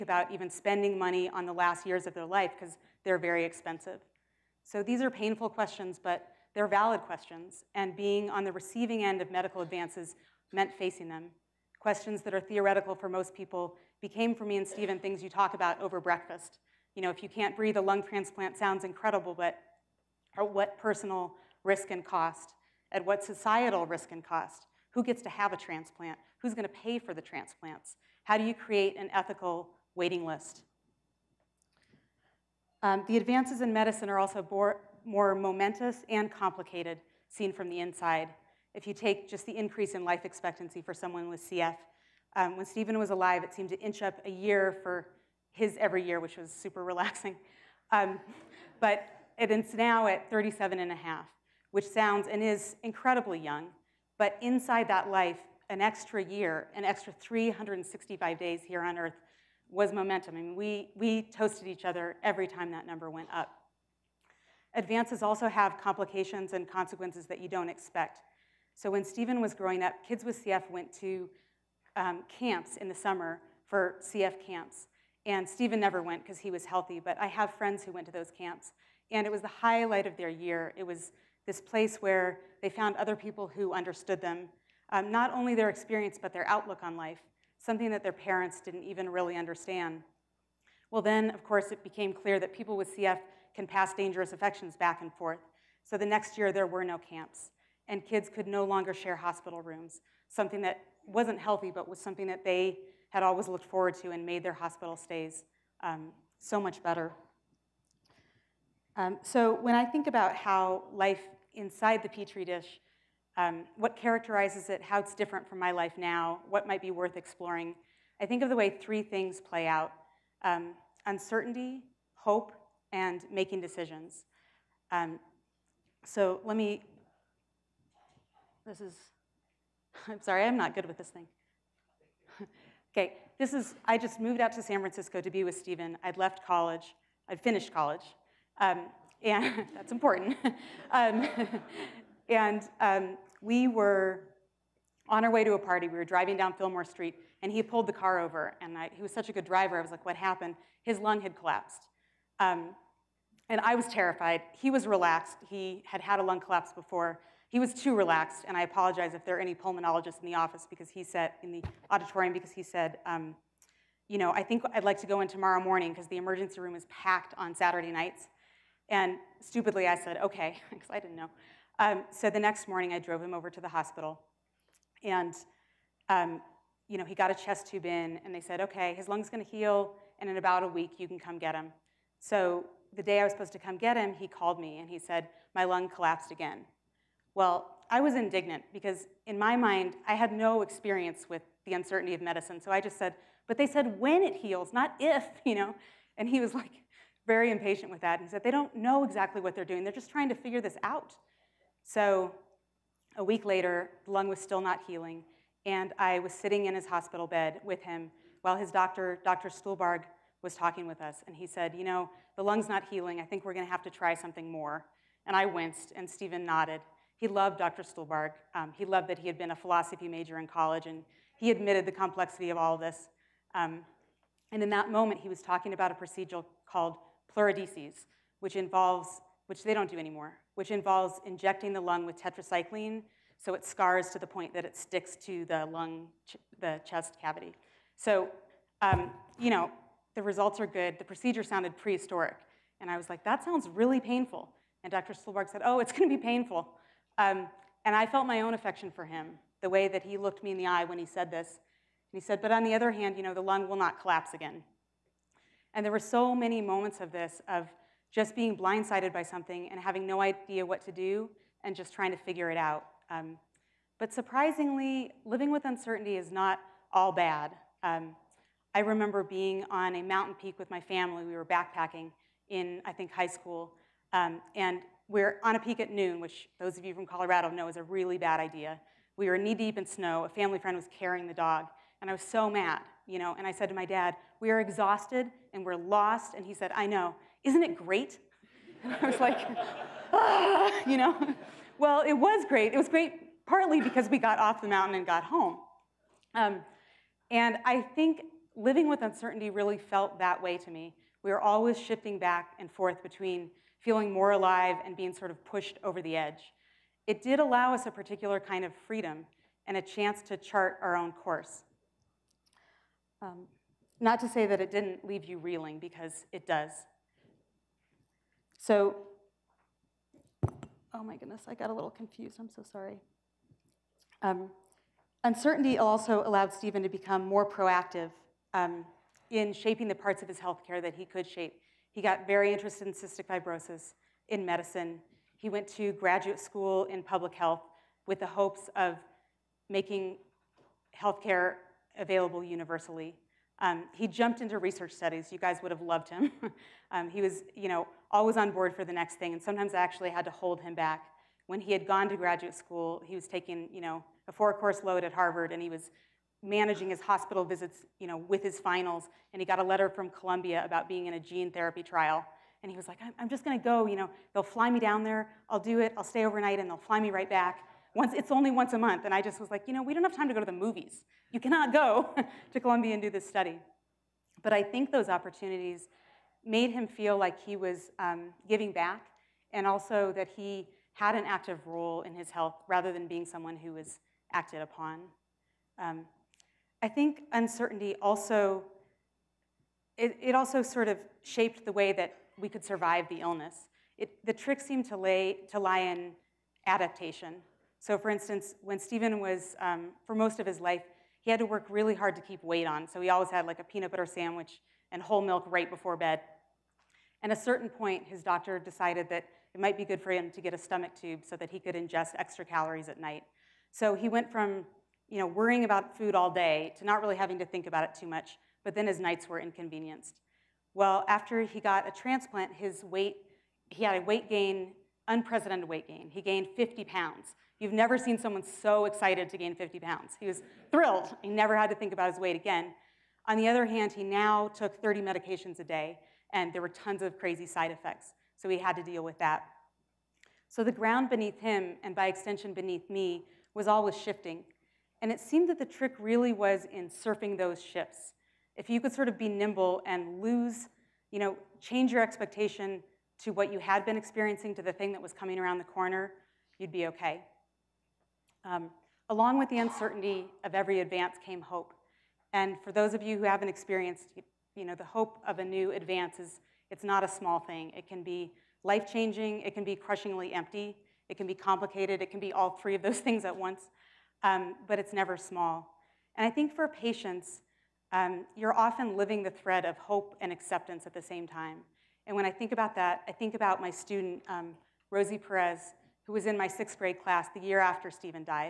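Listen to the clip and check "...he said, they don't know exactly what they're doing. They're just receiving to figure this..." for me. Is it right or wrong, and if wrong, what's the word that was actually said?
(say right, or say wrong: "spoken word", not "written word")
wrong: "trying", not "receiving".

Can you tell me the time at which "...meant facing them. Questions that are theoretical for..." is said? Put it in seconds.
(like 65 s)
10 s.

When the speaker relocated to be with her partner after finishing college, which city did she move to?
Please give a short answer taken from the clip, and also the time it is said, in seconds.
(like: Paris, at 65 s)
San Francisco, at 134 s.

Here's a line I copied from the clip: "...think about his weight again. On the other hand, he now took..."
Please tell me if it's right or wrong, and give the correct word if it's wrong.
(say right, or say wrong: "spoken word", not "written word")
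right.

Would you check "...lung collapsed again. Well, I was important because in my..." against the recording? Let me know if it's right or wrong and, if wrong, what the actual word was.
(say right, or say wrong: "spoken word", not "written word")
wrong: "indignant", not "important".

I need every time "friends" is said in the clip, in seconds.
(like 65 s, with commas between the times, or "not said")
77 s, 280 s.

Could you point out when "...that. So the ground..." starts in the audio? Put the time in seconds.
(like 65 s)
439 s.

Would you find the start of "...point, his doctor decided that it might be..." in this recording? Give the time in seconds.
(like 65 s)
407 s.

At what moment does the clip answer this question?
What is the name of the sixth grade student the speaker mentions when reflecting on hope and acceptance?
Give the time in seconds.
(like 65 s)
484 s.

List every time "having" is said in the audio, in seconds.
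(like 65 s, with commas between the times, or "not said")
259 s, 417 s.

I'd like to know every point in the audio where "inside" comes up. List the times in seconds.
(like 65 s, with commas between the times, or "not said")
37 s, 54 s, 111 s.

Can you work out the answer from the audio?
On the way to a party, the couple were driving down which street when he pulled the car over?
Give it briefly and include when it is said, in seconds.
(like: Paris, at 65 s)
Fillmore Street, at 146 s.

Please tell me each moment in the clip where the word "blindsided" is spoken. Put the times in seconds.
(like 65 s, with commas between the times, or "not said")
258 s.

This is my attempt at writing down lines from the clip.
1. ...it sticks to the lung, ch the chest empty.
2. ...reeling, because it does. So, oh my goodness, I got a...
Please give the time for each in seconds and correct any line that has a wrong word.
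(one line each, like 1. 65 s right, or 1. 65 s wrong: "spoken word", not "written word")
1. 234 s wrong: "cavity", not "empty"
2. 315 s right.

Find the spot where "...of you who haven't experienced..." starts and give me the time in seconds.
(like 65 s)
462 s.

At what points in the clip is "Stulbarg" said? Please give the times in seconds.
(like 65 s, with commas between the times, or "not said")
209 s, 217 s, 245 s.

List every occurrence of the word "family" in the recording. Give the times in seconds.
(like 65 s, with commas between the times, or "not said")
270 s, 280 s.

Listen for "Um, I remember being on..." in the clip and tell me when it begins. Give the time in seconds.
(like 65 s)
267 s.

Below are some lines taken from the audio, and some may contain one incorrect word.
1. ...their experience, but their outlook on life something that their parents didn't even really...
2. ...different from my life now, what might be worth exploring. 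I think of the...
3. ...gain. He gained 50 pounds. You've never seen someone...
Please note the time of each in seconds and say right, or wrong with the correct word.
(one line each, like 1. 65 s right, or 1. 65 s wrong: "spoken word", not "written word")
1. 85 s right
2. 115 s right
3. 425 s right.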